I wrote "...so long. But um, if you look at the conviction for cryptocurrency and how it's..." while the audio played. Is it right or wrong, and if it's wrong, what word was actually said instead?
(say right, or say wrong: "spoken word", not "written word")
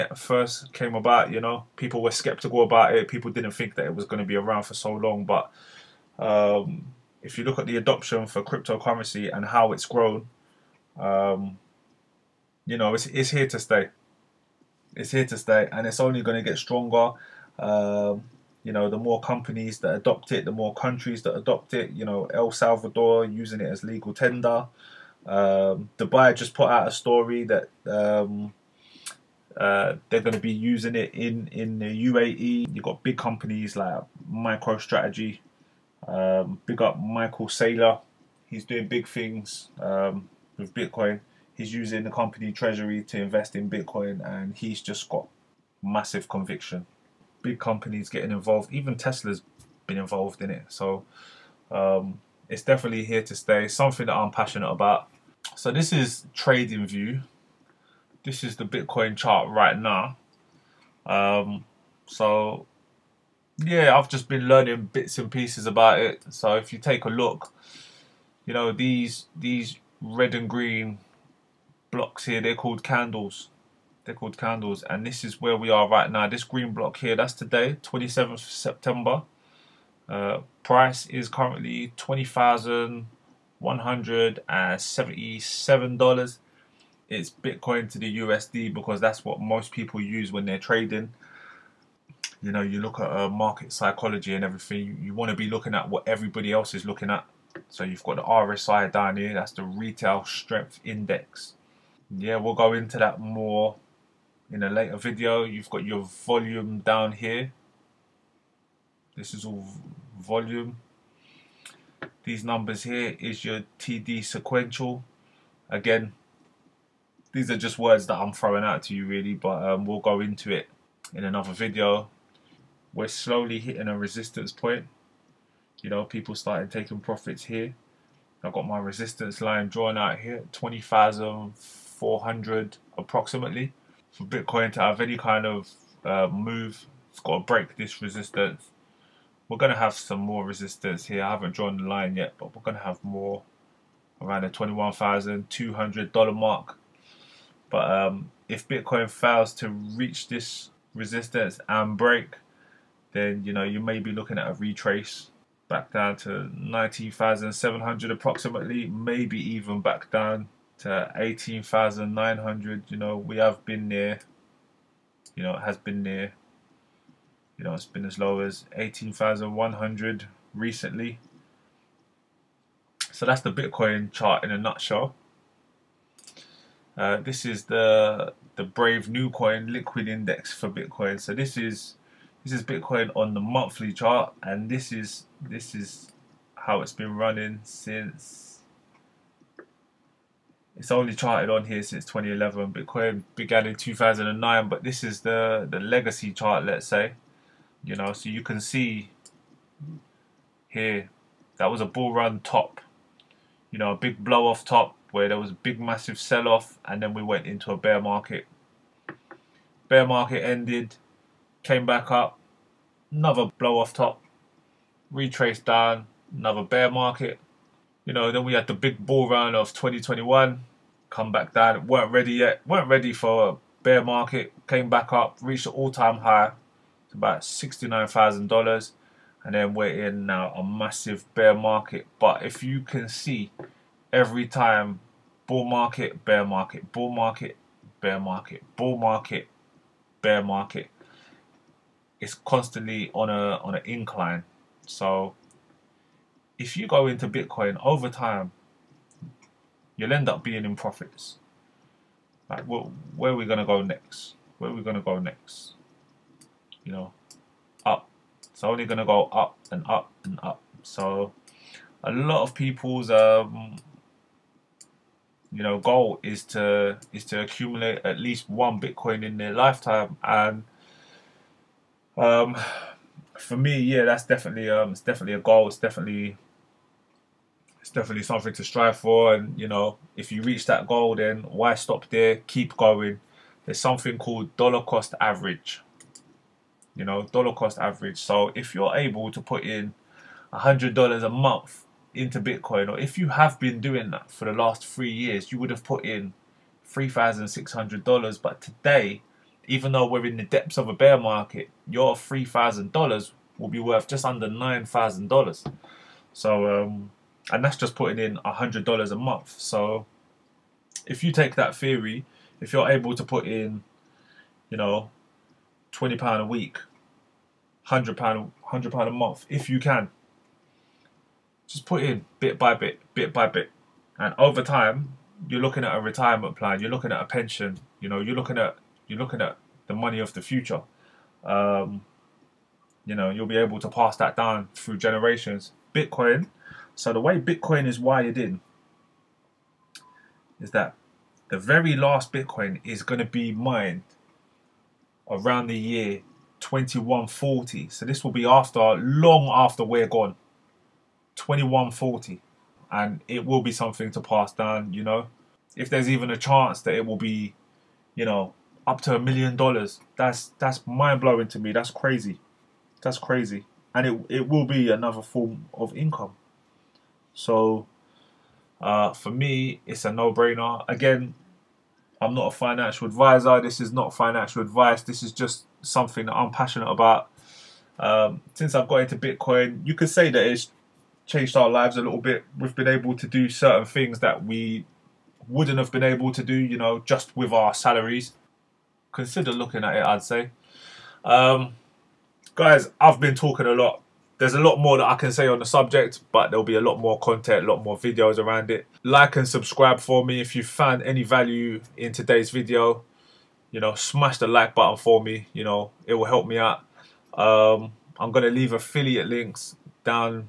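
wrong: "adoption", not "conviction".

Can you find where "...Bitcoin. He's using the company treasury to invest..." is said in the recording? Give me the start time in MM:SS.
00:40.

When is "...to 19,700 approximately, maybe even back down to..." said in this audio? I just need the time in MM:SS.
02:36.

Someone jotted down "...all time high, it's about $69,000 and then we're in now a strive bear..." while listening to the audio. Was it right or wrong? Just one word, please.
wrong.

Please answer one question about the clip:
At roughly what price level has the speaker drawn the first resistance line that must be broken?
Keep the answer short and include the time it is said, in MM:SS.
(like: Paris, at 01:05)
20,400, at 02:10.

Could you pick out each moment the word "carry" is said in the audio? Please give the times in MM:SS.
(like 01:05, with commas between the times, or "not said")
not said.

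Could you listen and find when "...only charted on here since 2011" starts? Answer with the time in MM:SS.
03:10.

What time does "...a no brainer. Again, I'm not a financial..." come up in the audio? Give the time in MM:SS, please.
06:10.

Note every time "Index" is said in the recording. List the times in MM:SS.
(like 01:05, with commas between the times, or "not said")
01:40, 03:00.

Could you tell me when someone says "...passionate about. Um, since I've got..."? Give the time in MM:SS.
06:16.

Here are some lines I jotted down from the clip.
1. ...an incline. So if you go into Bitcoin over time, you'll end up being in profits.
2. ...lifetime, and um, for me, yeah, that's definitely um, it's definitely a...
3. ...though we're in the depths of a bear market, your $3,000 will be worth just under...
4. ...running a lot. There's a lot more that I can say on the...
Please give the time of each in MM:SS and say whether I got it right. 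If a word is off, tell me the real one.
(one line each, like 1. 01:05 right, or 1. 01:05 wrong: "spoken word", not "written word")
1. 04:03 right
2. 04:29 right
3. 04:59 right
4. 06:33 wrong: "talking", not "running".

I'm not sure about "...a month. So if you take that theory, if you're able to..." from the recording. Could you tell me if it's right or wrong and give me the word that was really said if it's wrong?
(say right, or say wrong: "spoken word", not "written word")
right.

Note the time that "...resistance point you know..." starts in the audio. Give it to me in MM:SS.
02:03.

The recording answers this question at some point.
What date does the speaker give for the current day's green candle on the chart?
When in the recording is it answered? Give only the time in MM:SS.
01:17.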